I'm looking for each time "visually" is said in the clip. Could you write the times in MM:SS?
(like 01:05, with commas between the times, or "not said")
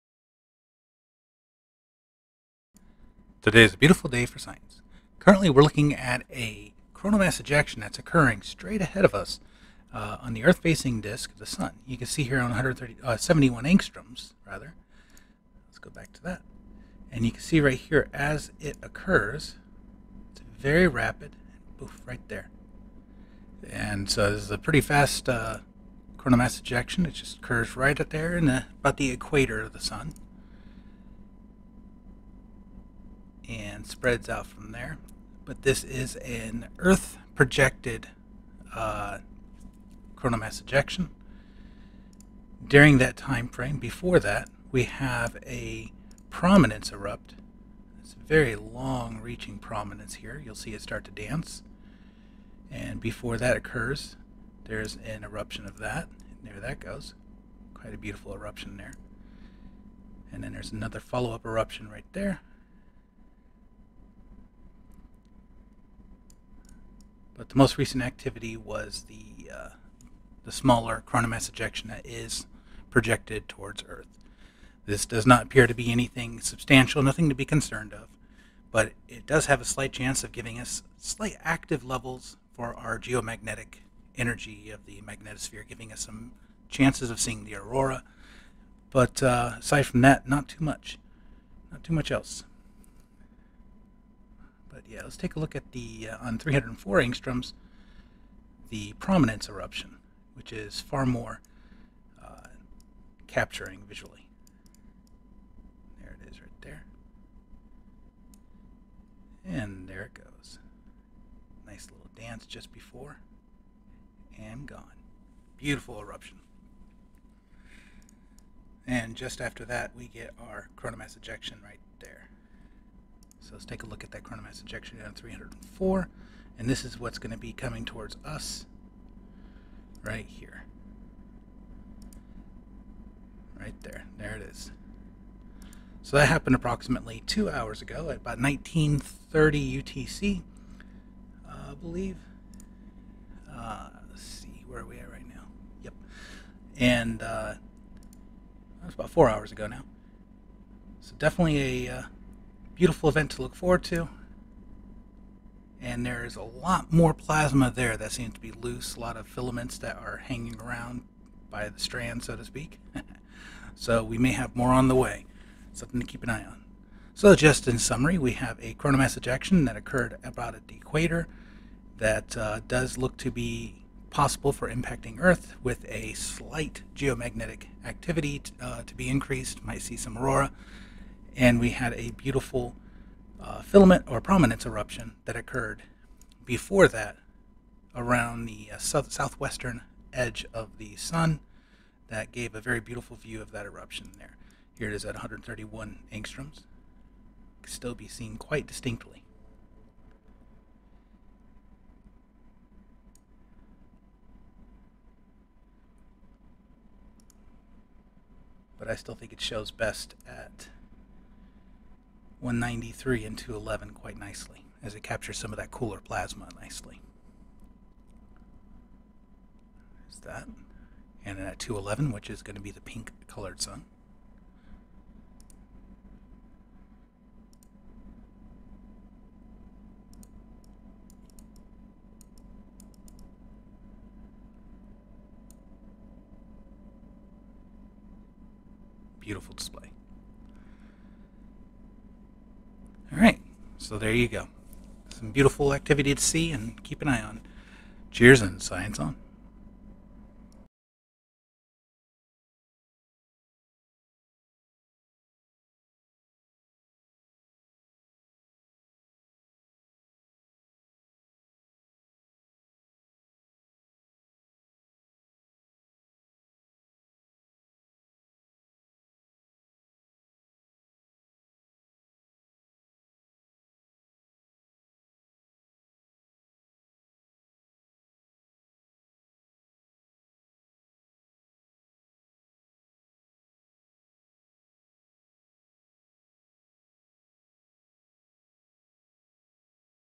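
01:43.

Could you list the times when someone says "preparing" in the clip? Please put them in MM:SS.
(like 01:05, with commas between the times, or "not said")
not said.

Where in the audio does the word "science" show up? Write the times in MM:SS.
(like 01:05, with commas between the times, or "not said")
00:04, 04:08.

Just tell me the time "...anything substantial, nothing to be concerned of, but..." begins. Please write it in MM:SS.
01:15.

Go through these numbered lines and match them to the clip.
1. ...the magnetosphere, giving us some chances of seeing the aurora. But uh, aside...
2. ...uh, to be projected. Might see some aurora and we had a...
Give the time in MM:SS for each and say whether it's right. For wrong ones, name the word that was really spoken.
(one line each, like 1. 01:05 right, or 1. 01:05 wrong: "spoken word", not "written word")
1. 01:24 right
2. 02:58 wrong: "increased", not "projected".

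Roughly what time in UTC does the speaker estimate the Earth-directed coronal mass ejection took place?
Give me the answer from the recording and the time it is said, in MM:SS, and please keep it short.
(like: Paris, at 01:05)
1930 UTC, at 02:18.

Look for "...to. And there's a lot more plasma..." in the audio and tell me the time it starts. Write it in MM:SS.
02:33.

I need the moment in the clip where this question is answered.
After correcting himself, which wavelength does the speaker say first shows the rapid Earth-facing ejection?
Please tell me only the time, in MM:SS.
00:13.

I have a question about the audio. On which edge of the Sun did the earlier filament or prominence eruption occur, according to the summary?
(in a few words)
South southwestern edge.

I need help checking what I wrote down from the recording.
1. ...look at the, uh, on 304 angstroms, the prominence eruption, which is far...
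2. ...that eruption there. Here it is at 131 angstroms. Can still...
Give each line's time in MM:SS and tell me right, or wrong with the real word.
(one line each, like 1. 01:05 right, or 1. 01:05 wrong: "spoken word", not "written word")
1. 01:35 right
2. 03:13 right.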